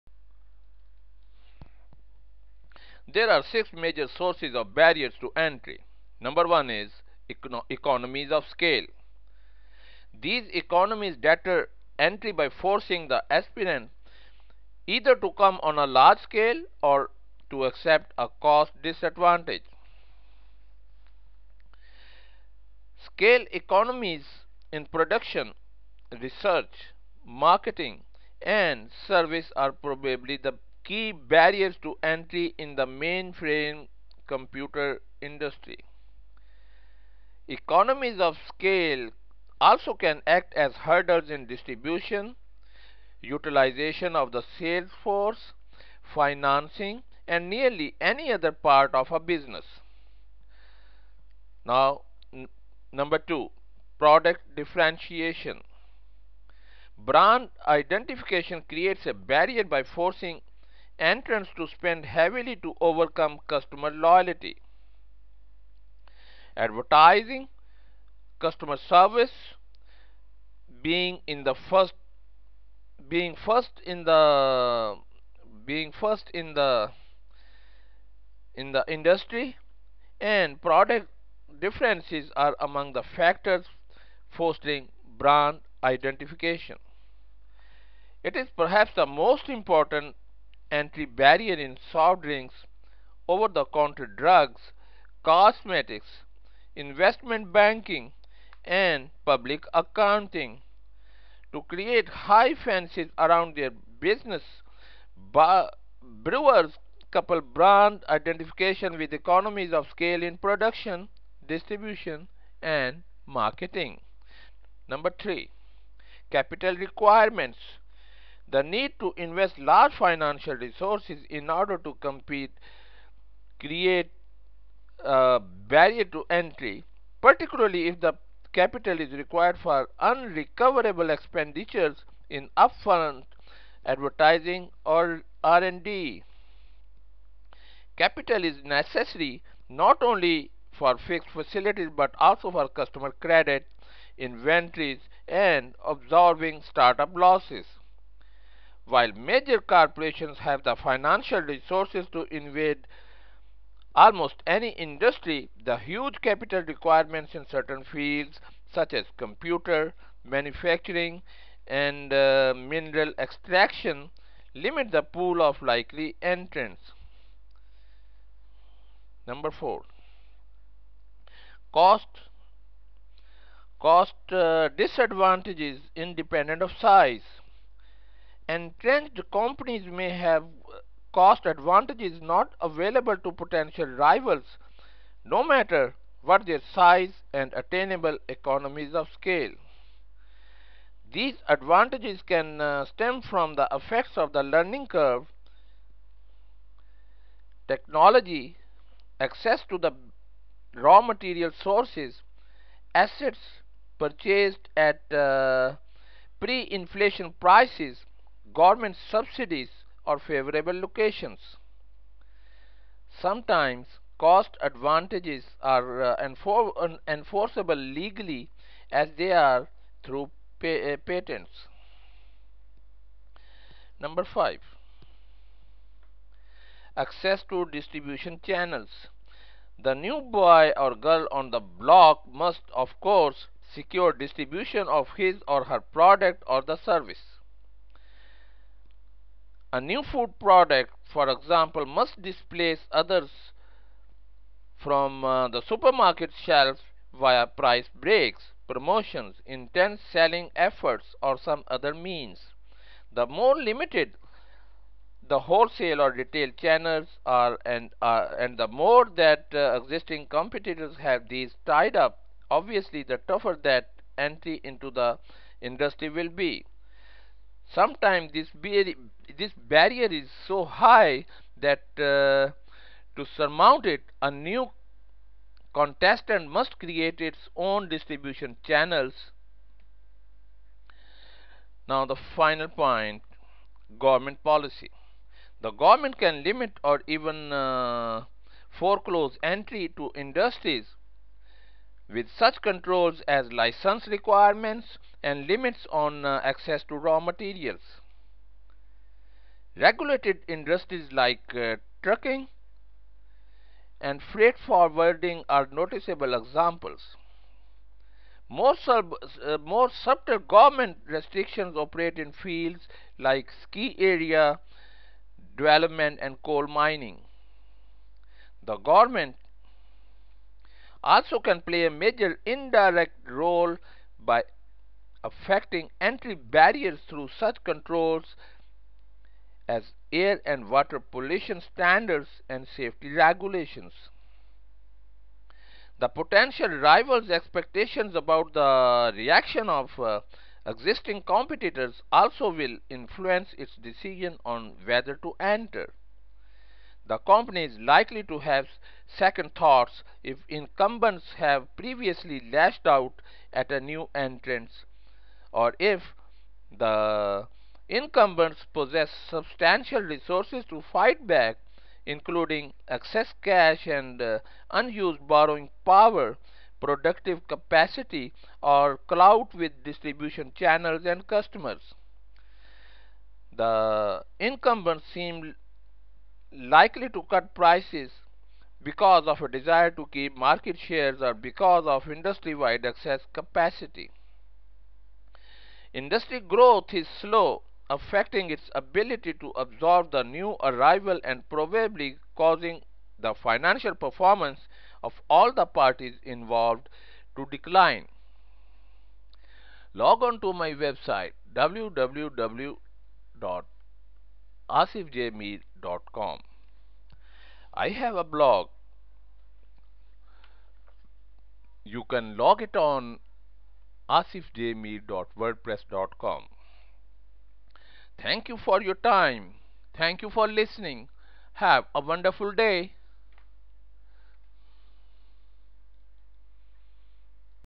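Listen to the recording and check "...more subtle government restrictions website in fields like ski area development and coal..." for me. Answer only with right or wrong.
wrong.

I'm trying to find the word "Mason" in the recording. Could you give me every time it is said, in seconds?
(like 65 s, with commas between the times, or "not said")
not said.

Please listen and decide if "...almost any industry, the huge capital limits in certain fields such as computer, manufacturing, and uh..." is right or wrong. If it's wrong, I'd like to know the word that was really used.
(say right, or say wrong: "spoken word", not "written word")
wrong: "requirements", not "limits".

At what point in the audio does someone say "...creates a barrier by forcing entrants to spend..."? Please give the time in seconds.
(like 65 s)
58 s.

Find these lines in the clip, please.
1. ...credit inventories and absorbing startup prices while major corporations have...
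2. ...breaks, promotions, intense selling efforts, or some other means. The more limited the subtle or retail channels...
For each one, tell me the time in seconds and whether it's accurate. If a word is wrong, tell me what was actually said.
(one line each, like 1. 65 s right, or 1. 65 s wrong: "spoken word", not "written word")
1. 143 s wrong: "losses", not "prices"
2. 247 s wrong: "wholesale", not "subtle".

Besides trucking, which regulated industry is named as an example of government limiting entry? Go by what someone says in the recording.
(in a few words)
freight forwarding.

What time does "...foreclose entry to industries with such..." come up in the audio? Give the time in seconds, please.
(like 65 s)
288 s.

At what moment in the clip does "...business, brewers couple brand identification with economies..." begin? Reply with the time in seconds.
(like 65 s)
103 s.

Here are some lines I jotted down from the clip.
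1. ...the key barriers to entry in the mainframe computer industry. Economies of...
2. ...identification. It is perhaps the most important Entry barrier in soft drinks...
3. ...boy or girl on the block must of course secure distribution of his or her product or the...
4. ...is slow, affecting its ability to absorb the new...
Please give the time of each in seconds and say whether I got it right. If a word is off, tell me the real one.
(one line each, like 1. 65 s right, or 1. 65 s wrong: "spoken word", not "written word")
1. 30 s right
2. 85 s right
3. 230 s right
4. 386 s right.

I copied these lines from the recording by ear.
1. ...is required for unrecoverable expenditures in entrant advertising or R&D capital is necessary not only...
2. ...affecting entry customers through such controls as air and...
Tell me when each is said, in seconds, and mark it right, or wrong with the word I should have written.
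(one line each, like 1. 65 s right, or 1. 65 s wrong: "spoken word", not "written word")
1. 128 s wrong: "upfront", not "entrant"
2. 325 s wrong: "barriers", not "customers".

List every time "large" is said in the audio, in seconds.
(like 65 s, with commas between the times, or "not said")
15 s, 119 s.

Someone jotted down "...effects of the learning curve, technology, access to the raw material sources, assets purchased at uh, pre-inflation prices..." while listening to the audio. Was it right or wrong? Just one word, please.
right.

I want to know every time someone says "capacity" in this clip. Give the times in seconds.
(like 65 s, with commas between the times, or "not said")
367 s, 383 s.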